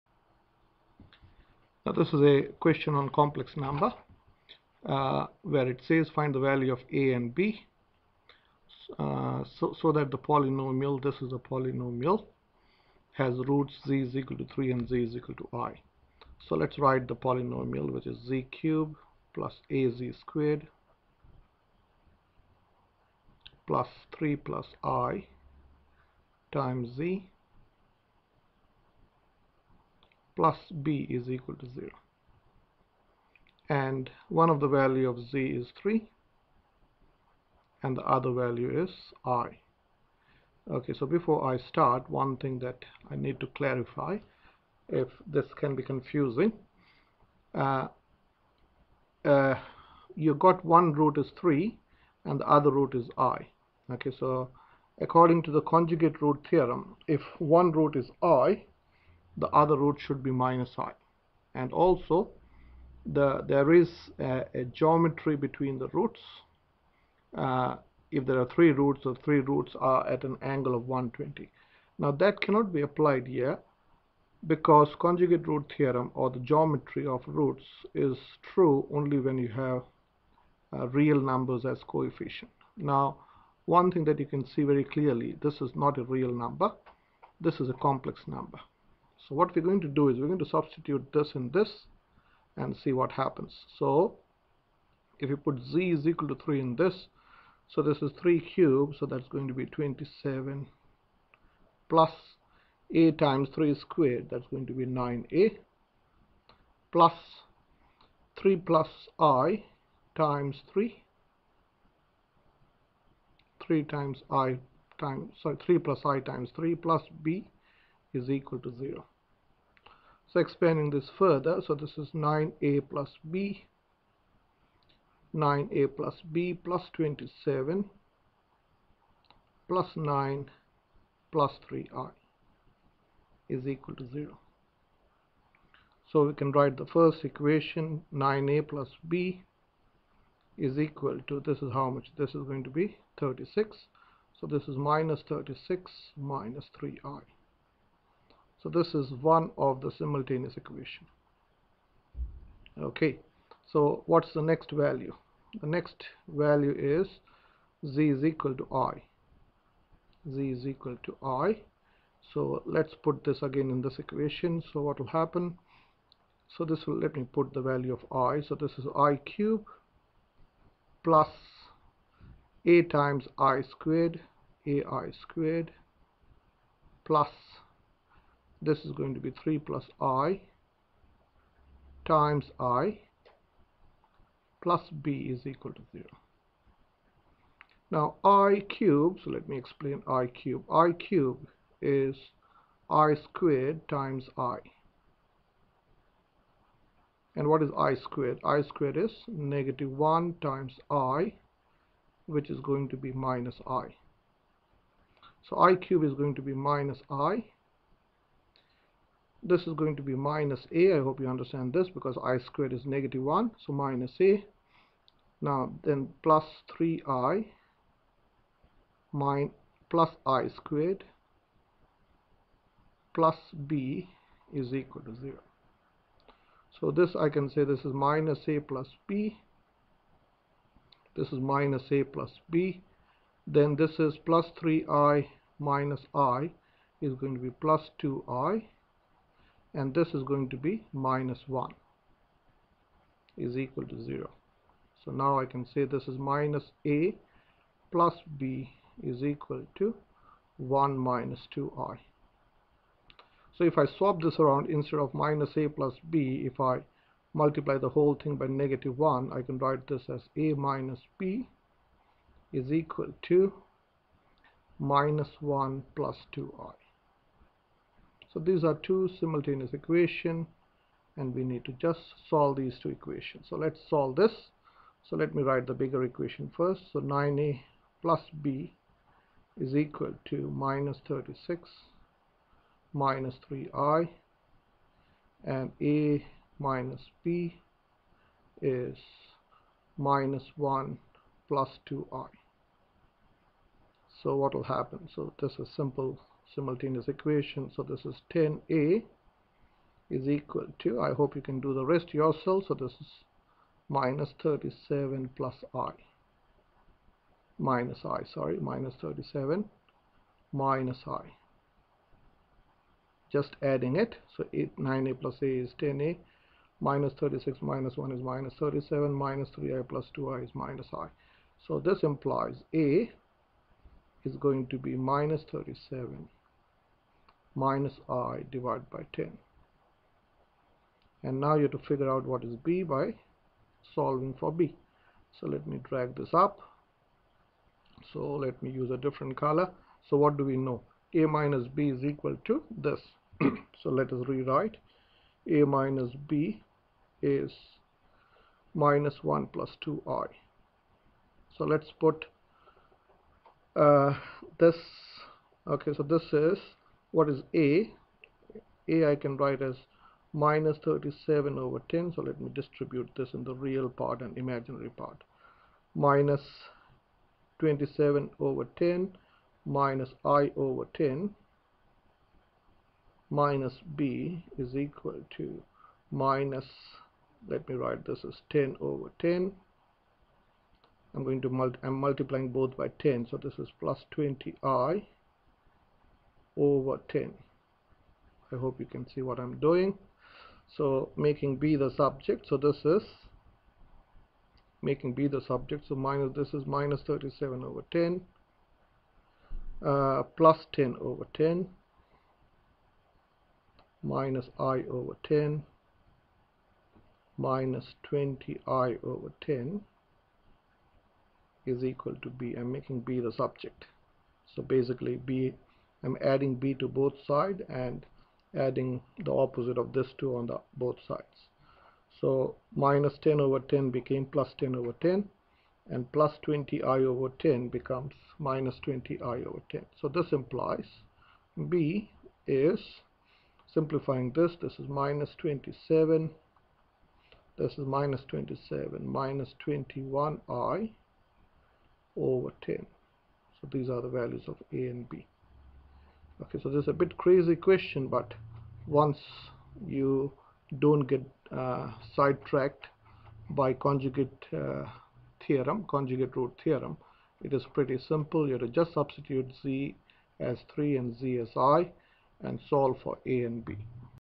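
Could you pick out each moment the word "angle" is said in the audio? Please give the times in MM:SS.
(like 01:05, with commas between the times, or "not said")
01:10.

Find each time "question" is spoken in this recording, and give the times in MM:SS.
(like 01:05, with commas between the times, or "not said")
00:02, 07:27.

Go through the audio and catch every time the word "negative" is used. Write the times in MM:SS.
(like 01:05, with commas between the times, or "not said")
03:19, 03:32, 04:18.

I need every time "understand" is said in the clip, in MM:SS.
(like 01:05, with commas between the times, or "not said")
03:31.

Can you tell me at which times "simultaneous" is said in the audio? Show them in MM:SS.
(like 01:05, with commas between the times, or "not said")
02:29, 04:29, 04:56.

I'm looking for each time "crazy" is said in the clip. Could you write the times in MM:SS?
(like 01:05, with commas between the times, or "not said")
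07:27.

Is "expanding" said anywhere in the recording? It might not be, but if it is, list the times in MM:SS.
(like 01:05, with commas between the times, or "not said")
02:00.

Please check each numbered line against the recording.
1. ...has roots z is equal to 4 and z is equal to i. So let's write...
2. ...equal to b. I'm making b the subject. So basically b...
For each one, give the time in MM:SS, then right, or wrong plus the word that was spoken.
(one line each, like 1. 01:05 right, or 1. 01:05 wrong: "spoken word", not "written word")
1. 00:13 wrong: "3", not "4"
2. 06:51 right.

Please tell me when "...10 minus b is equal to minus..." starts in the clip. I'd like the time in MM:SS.
06:10.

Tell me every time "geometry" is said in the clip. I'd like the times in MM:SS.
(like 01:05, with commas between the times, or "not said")
01:04, 01:16.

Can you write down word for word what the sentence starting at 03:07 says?
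Now i cube, so let me explain i cube.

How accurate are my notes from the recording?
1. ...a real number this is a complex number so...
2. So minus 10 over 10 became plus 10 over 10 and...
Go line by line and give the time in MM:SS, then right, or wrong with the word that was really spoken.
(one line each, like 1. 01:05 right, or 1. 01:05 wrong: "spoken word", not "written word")
1. 01:25 right
2. 07:02 right.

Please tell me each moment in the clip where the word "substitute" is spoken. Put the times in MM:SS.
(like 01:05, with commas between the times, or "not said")
01:30, 07:38.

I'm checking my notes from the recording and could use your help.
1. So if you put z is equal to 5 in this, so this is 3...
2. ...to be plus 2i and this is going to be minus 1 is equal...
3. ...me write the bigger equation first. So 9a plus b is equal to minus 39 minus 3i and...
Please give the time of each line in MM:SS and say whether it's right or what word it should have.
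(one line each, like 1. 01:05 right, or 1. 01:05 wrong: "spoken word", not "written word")
1. 01:33 wrong: "3", not "5"
2. 03:57 right
3. 04:35 wrong: "36", not "39".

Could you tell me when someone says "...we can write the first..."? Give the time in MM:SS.
02:16.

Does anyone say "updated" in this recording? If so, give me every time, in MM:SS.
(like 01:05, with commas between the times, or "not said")
not said.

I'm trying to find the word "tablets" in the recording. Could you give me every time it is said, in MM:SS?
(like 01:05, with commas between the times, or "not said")
not said.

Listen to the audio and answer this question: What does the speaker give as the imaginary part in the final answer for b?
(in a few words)
minus 21i.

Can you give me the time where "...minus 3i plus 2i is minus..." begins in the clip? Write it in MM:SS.
05:19.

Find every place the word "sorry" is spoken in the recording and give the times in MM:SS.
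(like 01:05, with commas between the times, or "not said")
01:55, 05:08.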